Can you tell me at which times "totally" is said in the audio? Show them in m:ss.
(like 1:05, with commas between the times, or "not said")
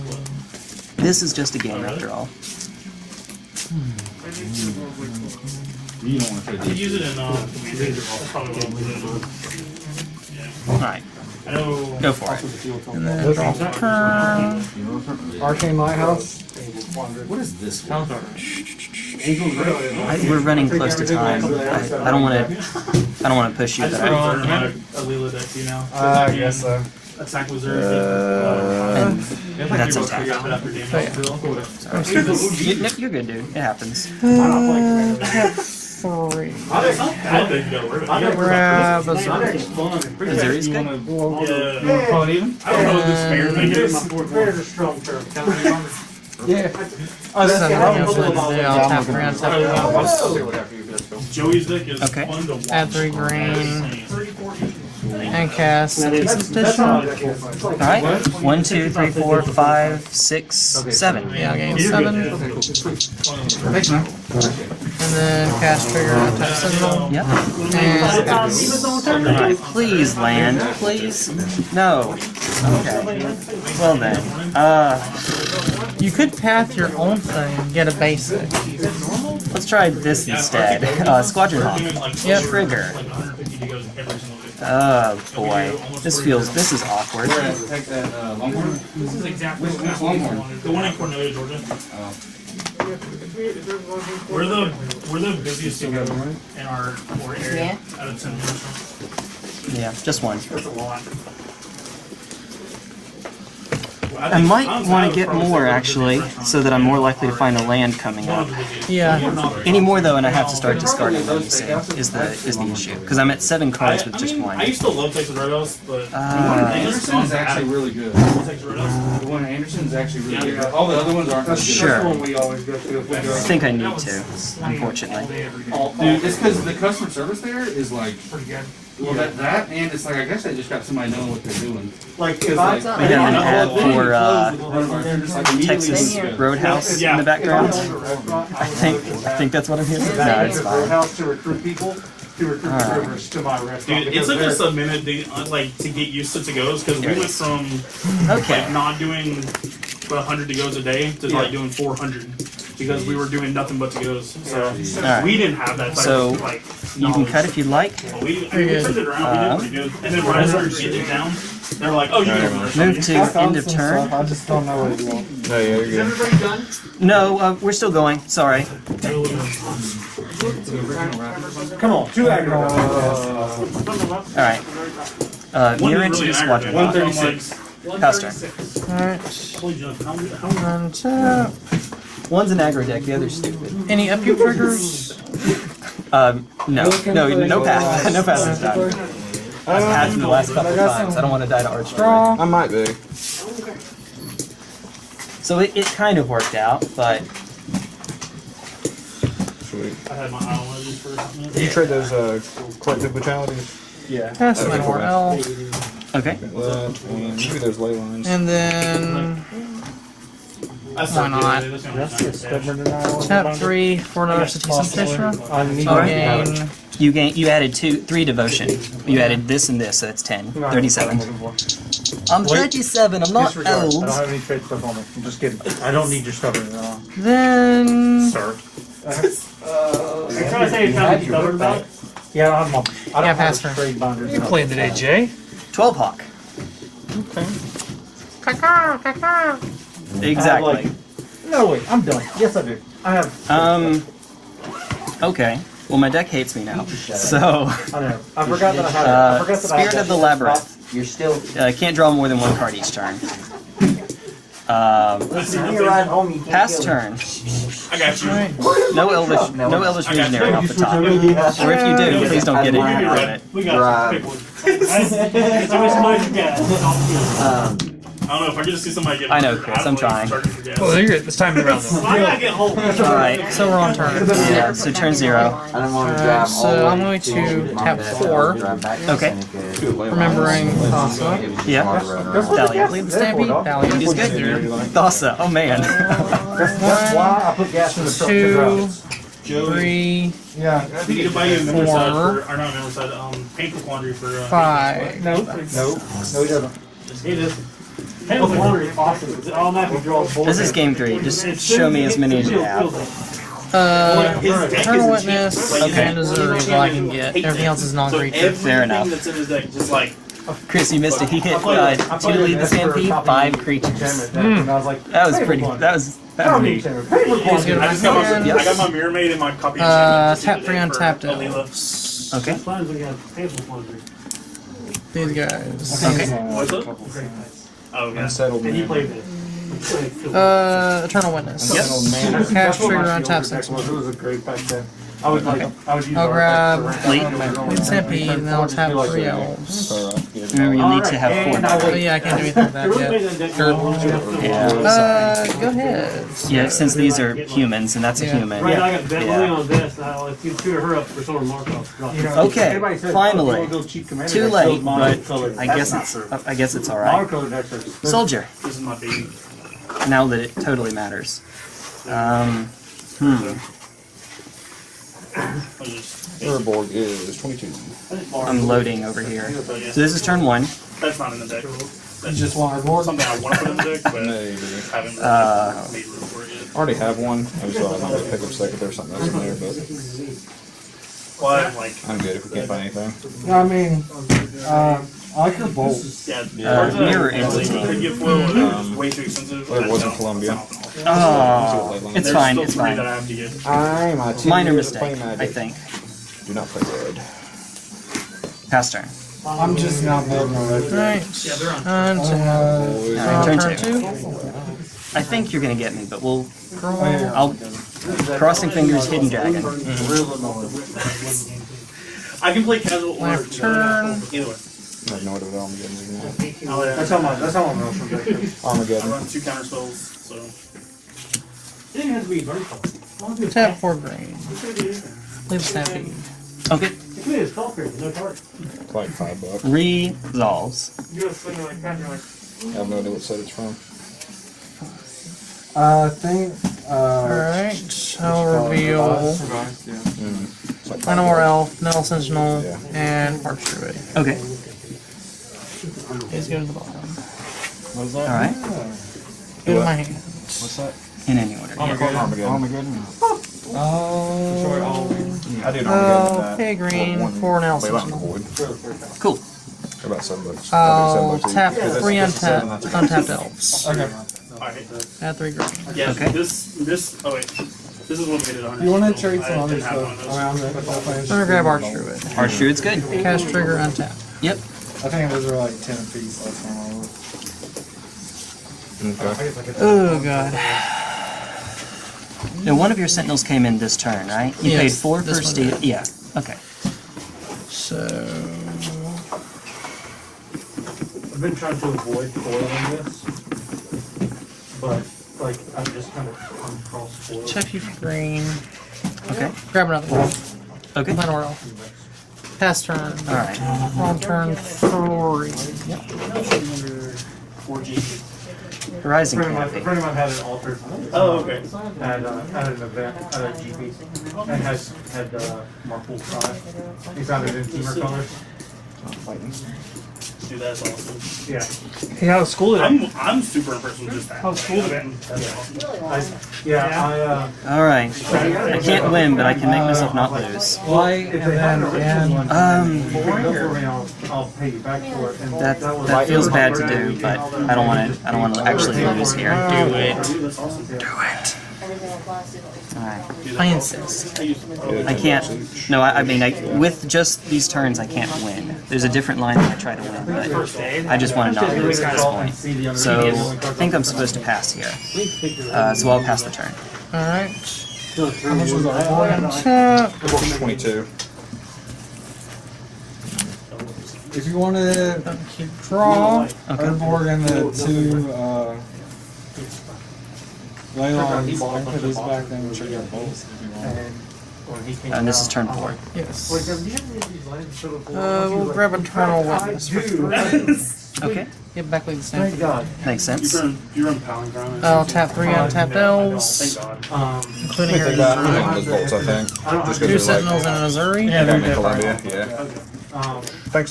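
6:00.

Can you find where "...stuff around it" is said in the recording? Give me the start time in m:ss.
7:49.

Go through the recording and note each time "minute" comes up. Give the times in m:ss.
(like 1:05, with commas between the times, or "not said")
2:24, 3:21.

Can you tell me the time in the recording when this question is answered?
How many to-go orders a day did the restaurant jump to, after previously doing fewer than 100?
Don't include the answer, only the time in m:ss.
2:31.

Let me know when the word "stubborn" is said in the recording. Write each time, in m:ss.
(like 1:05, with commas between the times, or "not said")
3:46, 3:51.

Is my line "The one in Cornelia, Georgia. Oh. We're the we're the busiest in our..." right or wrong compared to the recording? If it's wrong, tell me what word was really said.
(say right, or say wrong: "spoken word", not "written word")
right.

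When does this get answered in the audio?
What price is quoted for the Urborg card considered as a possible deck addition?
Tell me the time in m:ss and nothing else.
6:06.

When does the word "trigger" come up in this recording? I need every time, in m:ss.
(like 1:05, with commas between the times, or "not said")
1:05, 1:22, 3:04, 5:32, 7:53.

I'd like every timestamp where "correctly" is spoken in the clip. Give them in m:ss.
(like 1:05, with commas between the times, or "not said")
not said.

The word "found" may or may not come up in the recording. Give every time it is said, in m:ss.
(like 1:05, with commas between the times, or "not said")
8:37.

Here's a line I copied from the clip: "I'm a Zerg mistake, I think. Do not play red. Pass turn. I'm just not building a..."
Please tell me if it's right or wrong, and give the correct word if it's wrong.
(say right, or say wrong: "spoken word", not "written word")
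wrong: "Minor", not "Zerg".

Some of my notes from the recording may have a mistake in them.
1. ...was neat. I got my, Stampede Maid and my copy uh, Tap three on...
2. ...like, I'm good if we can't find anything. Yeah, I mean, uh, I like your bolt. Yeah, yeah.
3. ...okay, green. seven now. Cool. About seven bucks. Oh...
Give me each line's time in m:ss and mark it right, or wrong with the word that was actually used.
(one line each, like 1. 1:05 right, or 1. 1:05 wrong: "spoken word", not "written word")
1. 5:16 wrong: "Mirror", not "Stampede"
2. 6:21 right
3. 7:36 wrong: "four", not "seven".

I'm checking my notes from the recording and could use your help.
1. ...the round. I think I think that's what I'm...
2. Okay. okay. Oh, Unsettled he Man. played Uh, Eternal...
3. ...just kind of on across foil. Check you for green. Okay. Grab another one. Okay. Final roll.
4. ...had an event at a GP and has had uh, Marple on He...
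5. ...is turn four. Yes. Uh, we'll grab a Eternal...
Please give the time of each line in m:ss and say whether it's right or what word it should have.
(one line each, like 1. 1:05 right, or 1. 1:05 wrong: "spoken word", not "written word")
1. 2:17 wrong: "background", not "round"
2. 5:26 right
3. 8:15 right
4. 8:32 right
5. 9:35 right.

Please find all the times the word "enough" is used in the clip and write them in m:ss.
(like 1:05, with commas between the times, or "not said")
5:08.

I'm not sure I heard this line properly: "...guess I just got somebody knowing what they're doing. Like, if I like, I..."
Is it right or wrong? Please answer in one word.
right.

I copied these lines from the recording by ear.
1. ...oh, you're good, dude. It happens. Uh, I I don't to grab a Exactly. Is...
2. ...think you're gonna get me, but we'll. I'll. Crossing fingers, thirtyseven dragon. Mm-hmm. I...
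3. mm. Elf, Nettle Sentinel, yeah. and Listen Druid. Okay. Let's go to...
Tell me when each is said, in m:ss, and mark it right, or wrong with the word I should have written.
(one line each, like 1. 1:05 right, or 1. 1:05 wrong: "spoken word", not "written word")
1. 0:30 wrong: "Zerg", not "Exactly"
2. 6:45 wrong: "hidden", not "thirtyseven"
3. 7:19 wrong: "Park", not "Listen".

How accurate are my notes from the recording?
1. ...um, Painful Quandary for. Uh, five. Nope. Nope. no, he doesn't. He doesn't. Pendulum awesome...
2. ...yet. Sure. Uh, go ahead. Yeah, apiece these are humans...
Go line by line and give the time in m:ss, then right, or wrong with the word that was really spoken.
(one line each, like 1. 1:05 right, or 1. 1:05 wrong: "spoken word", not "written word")
1. 4:53 right
2. 5:44 wrong: "since", not "apiece".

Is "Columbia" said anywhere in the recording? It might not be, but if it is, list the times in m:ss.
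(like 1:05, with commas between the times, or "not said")
6:30, 9:51.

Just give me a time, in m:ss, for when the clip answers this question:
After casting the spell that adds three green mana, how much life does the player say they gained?
1:01.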